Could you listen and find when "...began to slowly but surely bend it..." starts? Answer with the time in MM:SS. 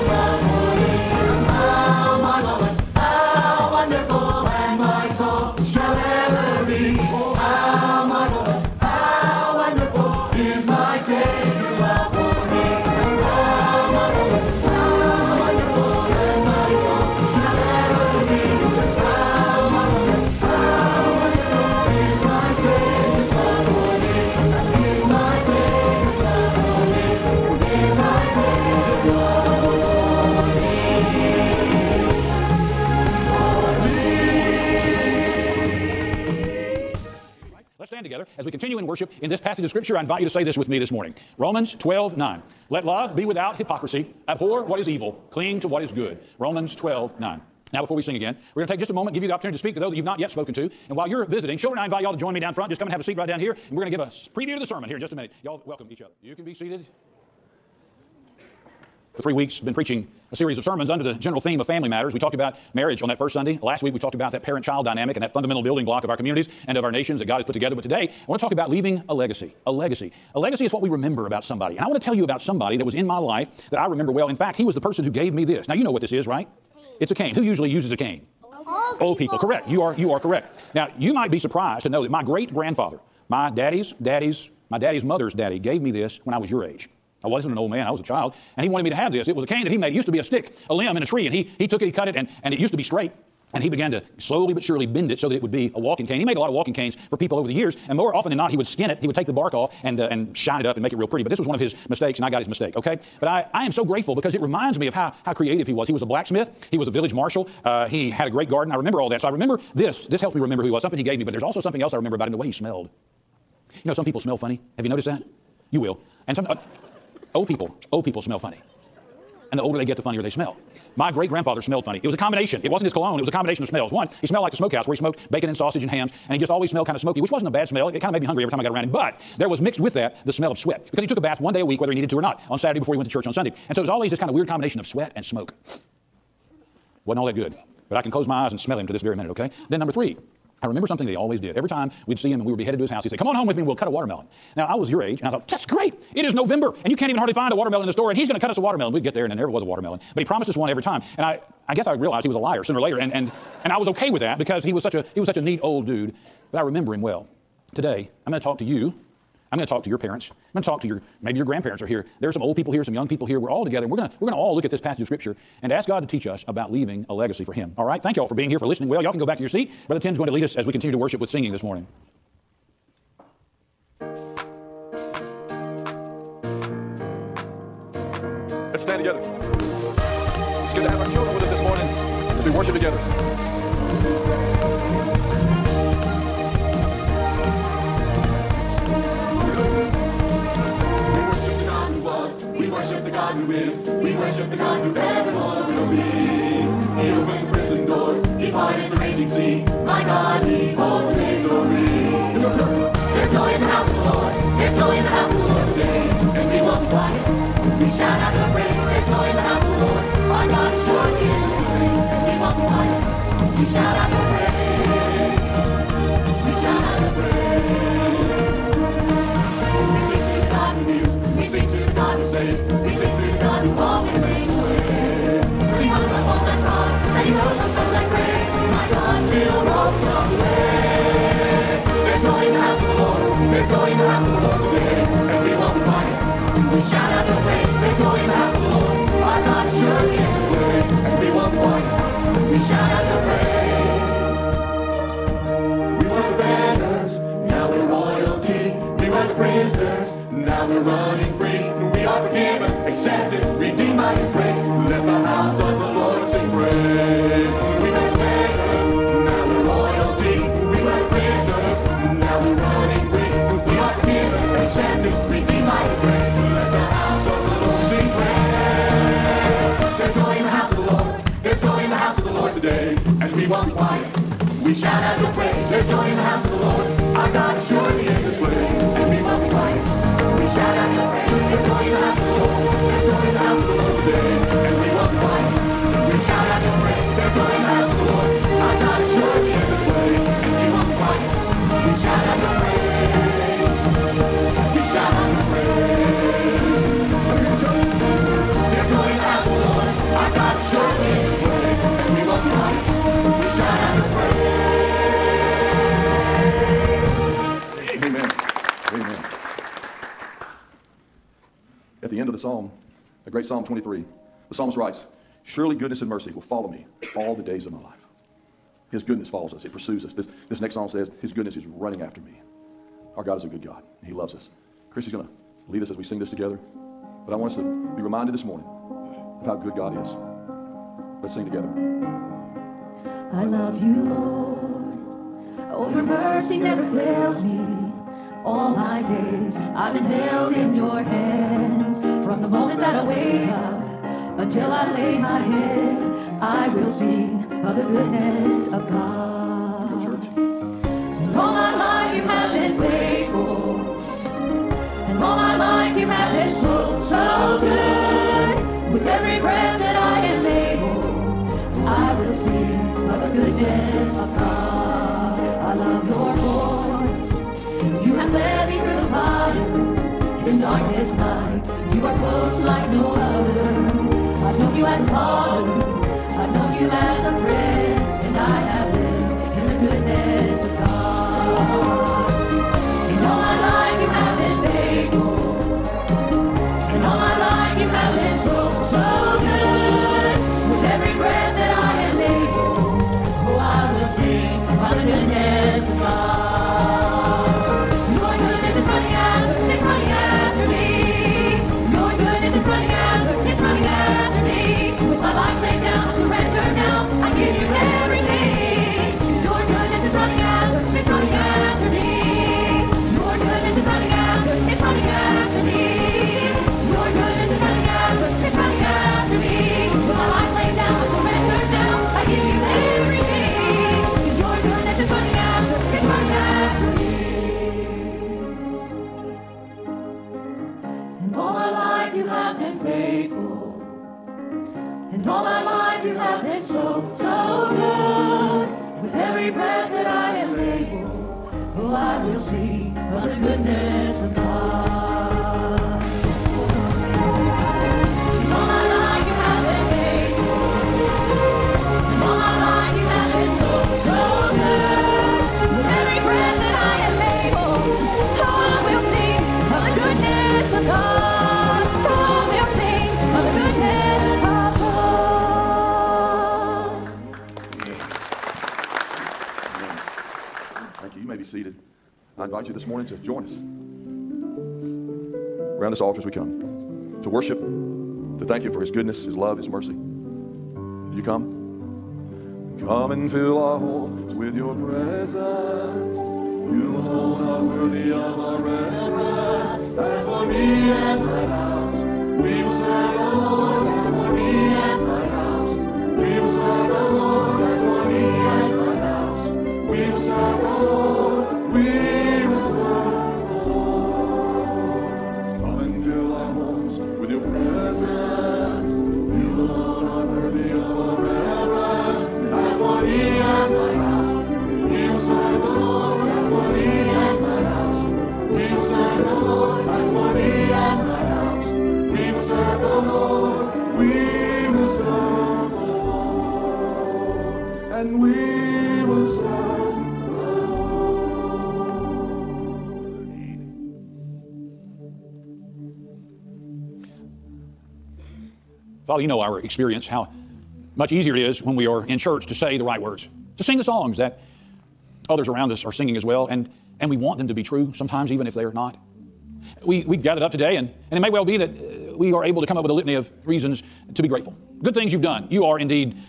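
01:33.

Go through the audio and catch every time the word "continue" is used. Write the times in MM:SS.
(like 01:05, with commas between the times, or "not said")
00:38, 02:50.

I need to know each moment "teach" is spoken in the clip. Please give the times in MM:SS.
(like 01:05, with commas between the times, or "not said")
02:46.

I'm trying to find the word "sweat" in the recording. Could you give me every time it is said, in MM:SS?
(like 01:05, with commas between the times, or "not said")
02:10, 02:14.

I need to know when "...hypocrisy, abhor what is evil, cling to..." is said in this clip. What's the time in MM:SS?
00:43.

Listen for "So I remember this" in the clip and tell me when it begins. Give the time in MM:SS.
01:49.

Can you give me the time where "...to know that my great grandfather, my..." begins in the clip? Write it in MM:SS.
01:21.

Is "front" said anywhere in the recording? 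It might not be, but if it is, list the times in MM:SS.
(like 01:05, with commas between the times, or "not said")
00:52.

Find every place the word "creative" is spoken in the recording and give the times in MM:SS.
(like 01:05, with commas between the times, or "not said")
01:45.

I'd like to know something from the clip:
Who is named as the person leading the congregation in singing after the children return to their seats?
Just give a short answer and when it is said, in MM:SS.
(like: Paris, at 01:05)
Brother Tim, at 02:49.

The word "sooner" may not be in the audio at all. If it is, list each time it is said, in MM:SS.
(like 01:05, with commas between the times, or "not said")
02:32.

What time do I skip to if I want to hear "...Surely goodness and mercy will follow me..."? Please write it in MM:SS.
05:15.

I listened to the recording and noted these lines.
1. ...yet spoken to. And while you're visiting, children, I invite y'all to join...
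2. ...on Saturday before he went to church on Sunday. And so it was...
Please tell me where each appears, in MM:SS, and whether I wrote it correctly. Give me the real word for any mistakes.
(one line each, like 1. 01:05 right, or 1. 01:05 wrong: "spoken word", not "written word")
1. 00:50 right
2. 02:12 right.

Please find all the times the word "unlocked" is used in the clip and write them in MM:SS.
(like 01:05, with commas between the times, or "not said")
not said.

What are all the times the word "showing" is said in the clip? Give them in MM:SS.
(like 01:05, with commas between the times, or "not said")
not said.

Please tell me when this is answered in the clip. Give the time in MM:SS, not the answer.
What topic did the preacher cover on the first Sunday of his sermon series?
01:02.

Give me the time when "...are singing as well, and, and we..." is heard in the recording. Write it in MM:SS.
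09:05.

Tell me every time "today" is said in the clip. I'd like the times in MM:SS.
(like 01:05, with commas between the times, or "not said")
01:07, 02:37, 09:10.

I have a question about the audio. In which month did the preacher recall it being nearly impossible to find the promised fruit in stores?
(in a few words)
November.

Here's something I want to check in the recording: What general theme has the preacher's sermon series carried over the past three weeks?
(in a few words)
Family matters.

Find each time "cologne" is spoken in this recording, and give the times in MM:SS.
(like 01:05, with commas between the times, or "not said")
02:02.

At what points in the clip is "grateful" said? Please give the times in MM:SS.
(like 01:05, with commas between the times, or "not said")
01:43, 09:14.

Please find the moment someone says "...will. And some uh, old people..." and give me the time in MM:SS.
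01:55.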